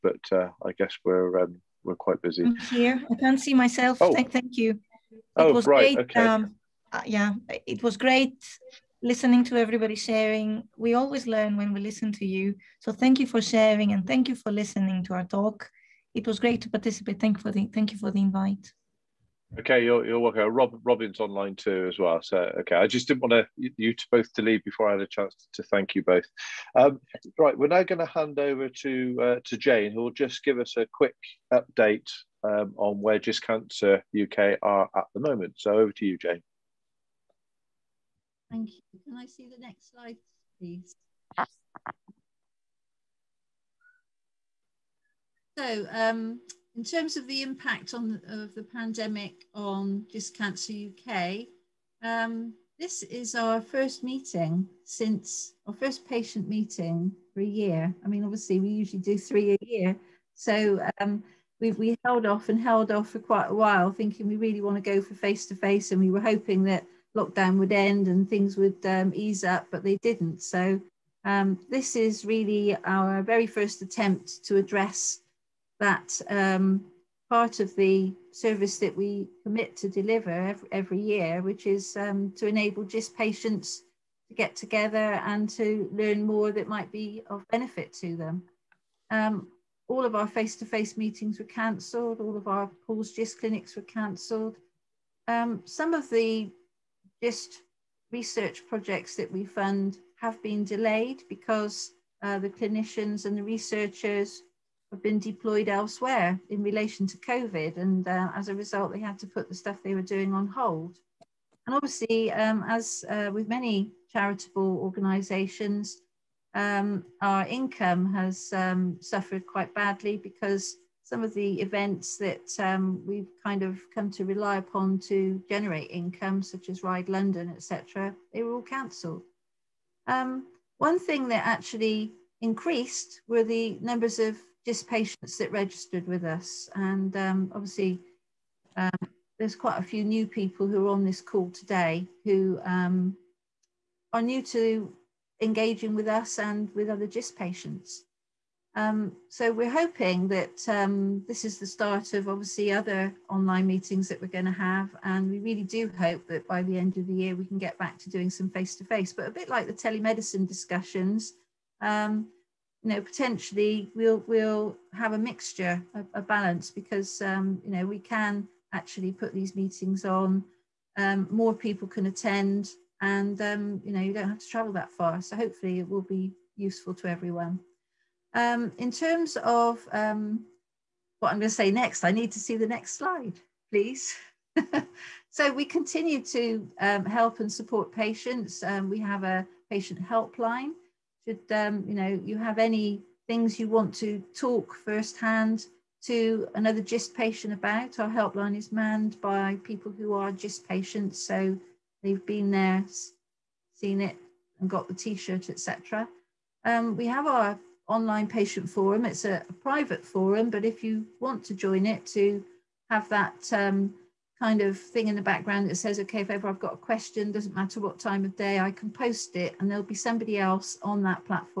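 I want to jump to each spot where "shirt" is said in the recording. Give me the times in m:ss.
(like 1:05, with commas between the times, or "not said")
3:24.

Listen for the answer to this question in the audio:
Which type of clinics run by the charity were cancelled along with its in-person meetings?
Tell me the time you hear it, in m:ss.
1:32.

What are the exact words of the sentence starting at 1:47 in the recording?
And uh, as a result, they had to put the stuff they were doing on hold.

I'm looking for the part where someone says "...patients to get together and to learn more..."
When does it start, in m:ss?
1:23.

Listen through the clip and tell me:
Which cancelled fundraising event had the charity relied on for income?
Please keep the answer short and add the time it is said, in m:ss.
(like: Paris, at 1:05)
Ride London, at 2:06.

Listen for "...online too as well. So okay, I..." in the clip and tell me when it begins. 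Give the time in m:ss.
0:21.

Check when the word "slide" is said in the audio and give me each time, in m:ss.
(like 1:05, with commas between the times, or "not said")
0:39, 3:02.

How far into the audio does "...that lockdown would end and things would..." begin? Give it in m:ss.
1:06.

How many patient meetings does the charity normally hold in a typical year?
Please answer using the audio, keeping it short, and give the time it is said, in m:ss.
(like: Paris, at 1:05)
3, at 0:59.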